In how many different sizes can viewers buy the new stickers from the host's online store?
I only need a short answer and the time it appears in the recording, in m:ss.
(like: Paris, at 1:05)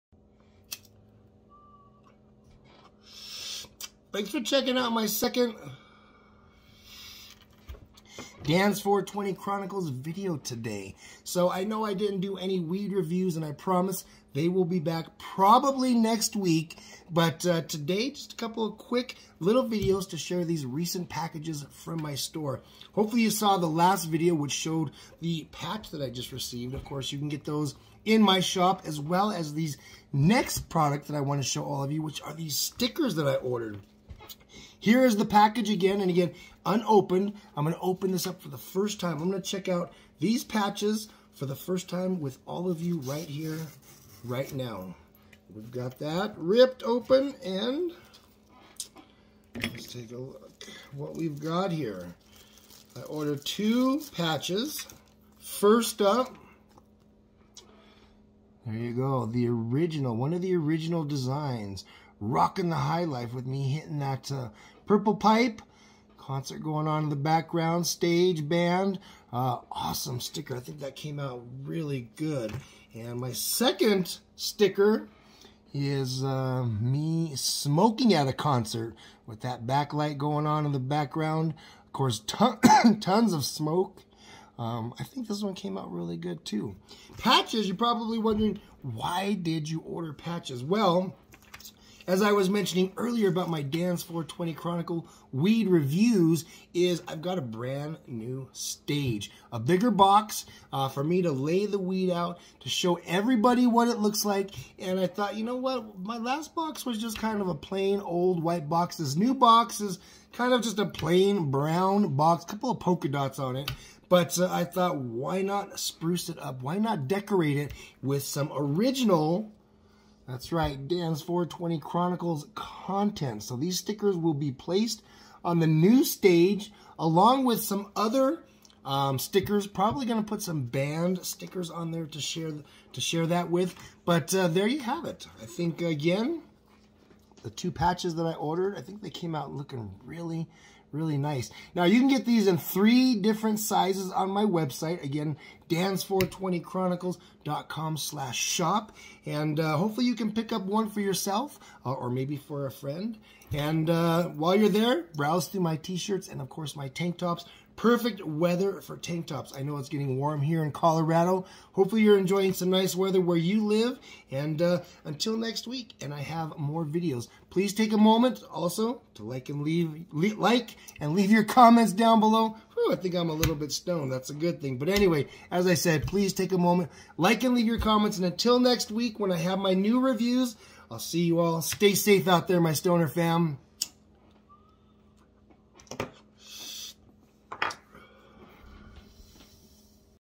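3, at 2:22.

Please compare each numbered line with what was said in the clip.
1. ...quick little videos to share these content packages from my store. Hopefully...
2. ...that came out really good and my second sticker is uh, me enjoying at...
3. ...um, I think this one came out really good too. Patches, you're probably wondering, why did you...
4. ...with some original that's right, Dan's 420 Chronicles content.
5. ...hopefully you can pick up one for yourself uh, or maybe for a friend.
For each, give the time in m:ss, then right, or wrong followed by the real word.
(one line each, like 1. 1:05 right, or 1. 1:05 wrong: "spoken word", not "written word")
1. 0:18 wrong: "recent", not "content"
2. 1:10 wrong: "smoking", not "enjoying"
3. 1:24 right
4. 1:58 right
5. 2:29 right.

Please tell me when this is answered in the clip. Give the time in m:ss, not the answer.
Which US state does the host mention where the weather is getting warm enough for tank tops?
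2:40.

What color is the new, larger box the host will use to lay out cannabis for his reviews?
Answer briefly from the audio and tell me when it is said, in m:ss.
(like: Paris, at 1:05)
Brown, at 1:51.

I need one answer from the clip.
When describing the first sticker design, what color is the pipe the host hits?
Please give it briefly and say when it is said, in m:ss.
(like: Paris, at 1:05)
Purple, at 1:04.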